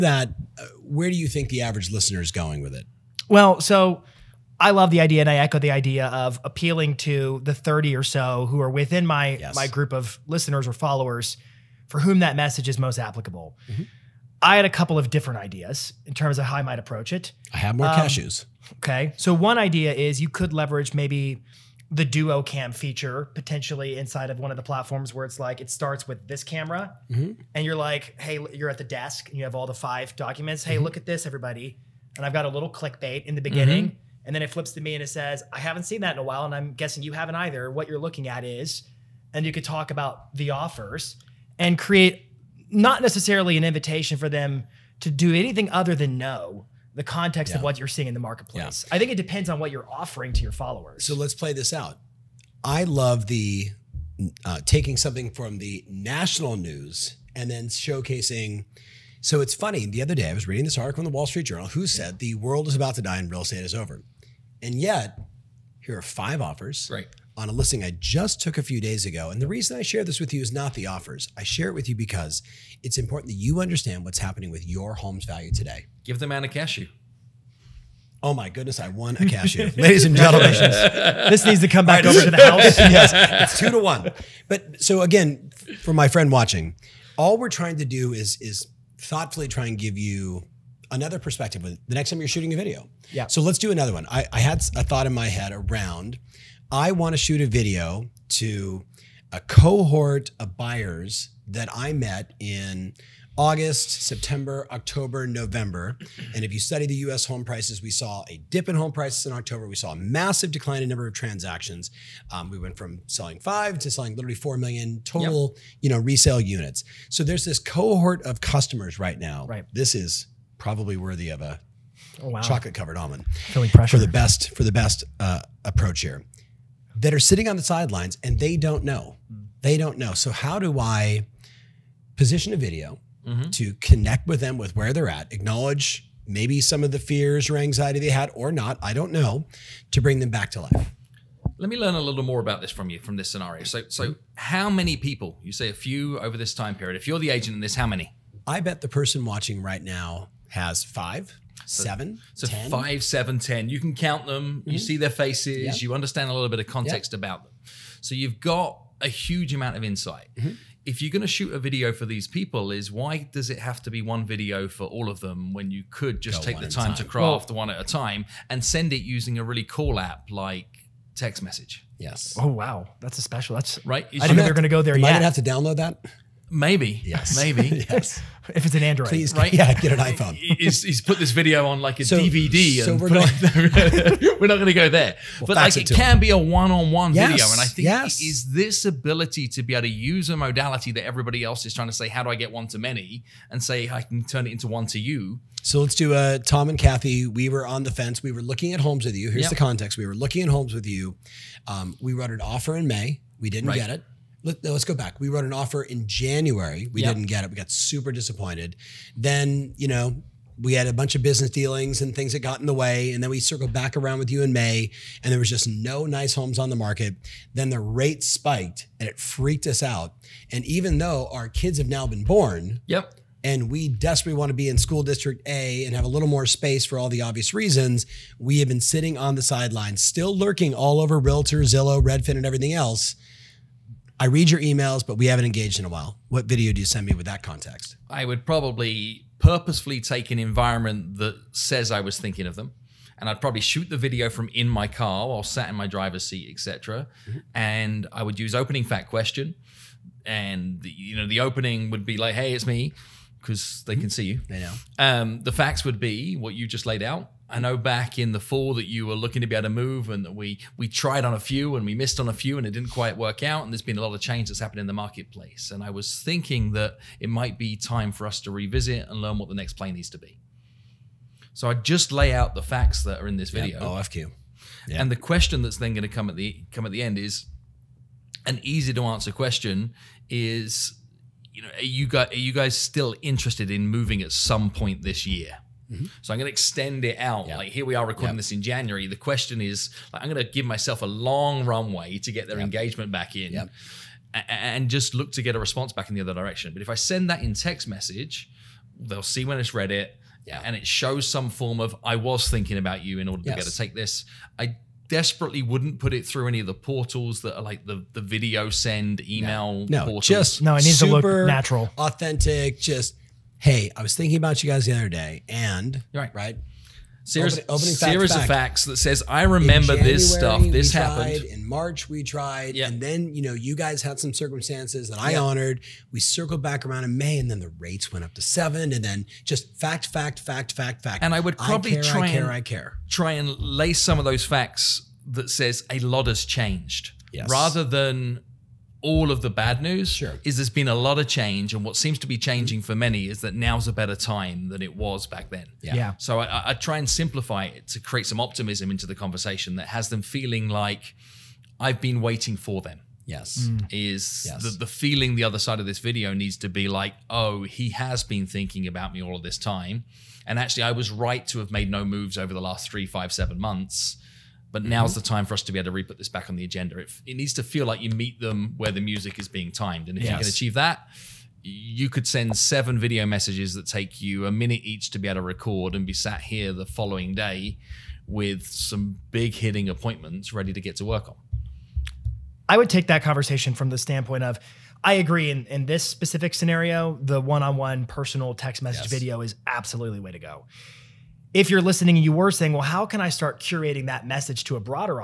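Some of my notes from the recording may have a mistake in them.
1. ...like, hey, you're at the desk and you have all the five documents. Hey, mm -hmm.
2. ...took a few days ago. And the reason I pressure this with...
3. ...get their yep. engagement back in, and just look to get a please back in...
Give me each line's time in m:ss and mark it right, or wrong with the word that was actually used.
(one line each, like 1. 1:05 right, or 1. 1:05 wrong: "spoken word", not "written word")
1. 0:27 right
2. 1:08 wrong: "share", not "pressure"
3. 4:52 wrong: "response", not "please".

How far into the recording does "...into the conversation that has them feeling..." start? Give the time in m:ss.
5:48.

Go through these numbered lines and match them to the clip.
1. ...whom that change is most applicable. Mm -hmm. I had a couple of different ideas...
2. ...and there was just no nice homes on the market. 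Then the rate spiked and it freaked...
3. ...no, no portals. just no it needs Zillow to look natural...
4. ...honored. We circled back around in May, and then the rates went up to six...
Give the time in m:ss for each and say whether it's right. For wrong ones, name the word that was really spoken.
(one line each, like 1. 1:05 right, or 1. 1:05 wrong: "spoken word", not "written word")
1. 0:11 wrong: "message", not "change"
2. 3:35 right
3. 5:09 wrong: "Super", not "Zillow"
4. 5:25 wrong: "seven", not "six".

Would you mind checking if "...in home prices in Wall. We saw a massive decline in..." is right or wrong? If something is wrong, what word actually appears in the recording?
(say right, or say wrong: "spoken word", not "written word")
wrong: "October", not "Wall".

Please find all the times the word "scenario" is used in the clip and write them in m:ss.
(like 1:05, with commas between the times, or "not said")
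2:23, 6:26.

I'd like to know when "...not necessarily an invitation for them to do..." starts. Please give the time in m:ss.
0:42.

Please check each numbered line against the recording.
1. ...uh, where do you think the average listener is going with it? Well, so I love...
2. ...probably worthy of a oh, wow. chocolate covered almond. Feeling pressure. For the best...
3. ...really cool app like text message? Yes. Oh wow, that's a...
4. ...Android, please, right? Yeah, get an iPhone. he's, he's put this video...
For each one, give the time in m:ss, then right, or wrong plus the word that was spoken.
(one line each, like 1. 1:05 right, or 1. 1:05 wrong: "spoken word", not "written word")
1. 0:00 right
2. 2:00 right
3. 2:49 right
4. 2:58 right.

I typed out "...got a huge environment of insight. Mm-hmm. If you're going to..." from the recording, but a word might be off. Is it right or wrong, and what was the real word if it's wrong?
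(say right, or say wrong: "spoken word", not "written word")
wrong: "amount", not "environment".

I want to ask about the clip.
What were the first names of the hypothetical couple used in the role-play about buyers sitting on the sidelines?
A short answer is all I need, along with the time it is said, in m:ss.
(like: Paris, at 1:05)
Tom and Kathy, at 3:16.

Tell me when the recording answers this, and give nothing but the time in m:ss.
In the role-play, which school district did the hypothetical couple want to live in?
3:44.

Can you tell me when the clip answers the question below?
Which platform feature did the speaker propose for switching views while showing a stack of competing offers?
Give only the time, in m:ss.
0:22.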